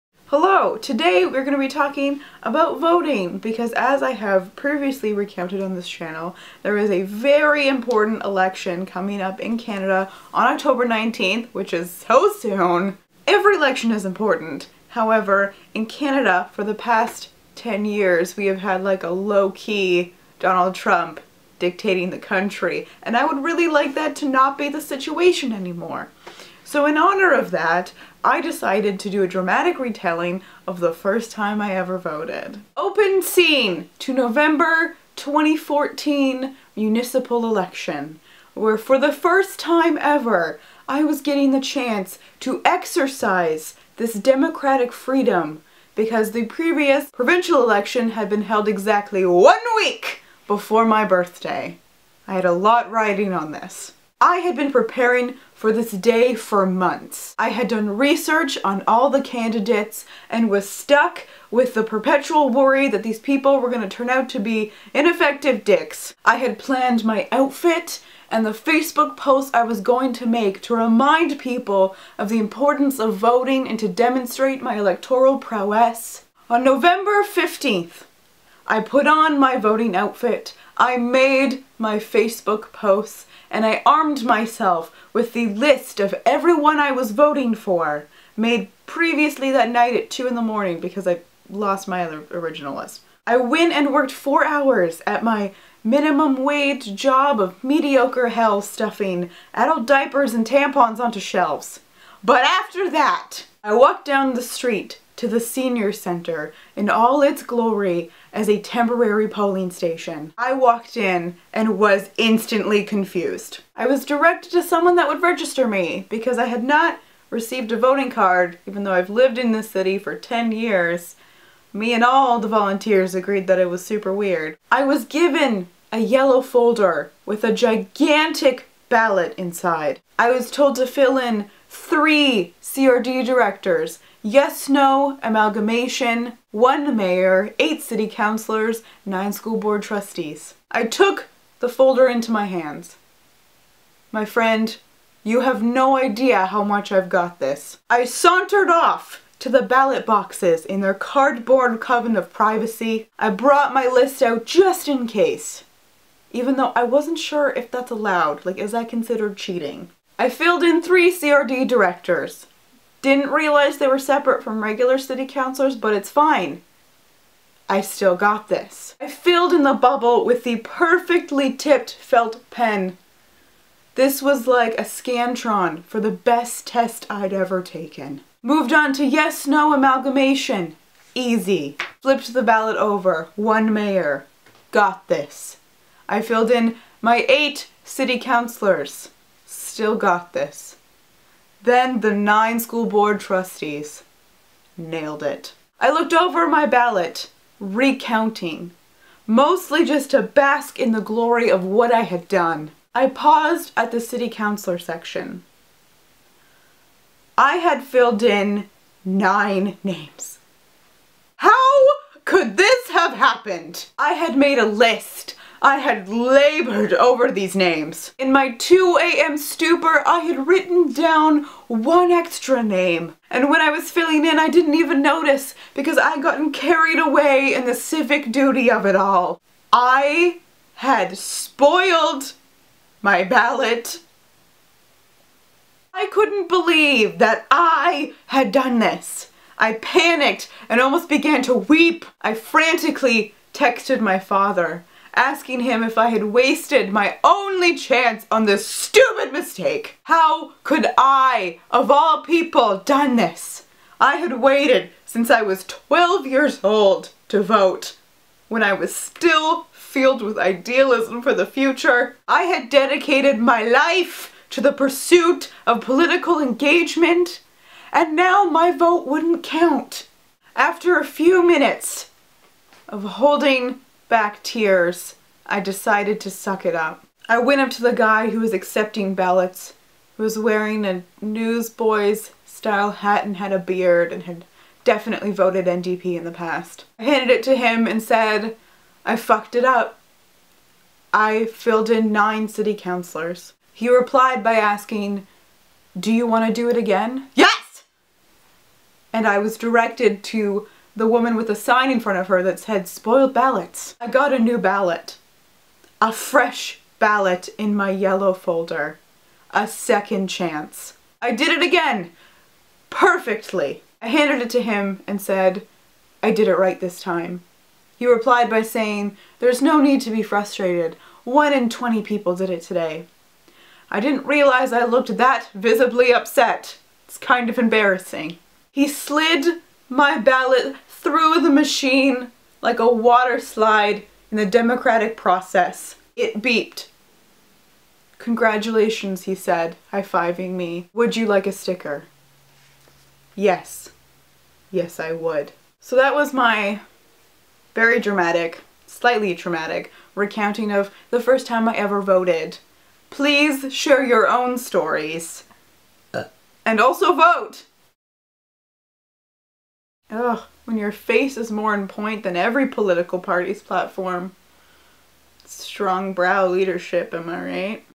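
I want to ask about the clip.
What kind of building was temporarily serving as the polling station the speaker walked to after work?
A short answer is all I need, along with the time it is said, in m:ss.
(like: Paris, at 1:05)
Senior center, at 1:45.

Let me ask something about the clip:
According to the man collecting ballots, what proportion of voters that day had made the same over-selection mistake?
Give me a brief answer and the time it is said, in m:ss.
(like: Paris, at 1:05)
1 in 20, at 5:21.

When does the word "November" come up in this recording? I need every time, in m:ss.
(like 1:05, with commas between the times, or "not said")
0:34, 1:16.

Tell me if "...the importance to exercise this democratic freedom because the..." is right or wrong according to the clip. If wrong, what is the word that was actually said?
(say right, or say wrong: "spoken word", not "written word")
wrong: "chance", not "importance".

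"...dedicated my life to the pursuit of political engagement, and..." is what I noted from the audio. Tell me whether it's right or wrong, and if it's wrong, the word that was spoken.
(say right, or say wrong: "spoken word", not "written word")
right.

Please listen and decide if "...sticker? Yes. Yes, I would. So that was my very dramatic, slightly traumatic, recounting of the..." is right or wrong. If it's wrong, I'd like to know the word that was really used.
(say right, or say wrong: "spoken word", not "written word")
right.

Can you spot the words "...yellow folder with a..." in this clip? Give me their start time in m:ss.
2:05.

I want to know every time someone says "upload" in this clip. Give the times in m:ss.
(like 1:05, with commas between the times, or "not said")
not said.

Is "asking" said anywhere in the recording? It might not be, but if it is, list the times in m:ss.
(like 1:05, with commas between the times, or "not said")
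4:05, 4:54.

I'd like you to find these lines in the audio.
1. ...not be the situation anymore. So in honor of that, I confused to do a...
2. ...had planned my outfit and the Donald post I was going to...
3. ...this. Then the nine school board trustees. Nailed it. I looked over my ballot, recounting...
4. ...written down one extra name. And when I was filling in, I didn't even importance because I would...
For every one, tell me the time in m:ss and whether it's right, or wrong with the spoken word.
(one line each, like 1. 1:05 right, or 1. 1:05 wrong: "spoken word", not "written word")
1. 0:24 wrong: "decided", not "confused"
2. 1:06 wrong: "Facebook", not "Donald"
3. 3:10 right
4. 3:40 wrong: "notice", not "importance".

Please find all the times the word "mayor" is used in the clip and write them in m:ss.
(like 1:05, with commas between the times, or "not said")
2:16, 3:03.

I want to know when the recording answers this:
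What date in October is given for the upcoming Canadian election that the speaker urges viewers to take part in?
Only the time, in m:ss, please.
0:10.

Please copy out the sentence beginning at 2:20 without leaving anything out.
I took the folder into my hands.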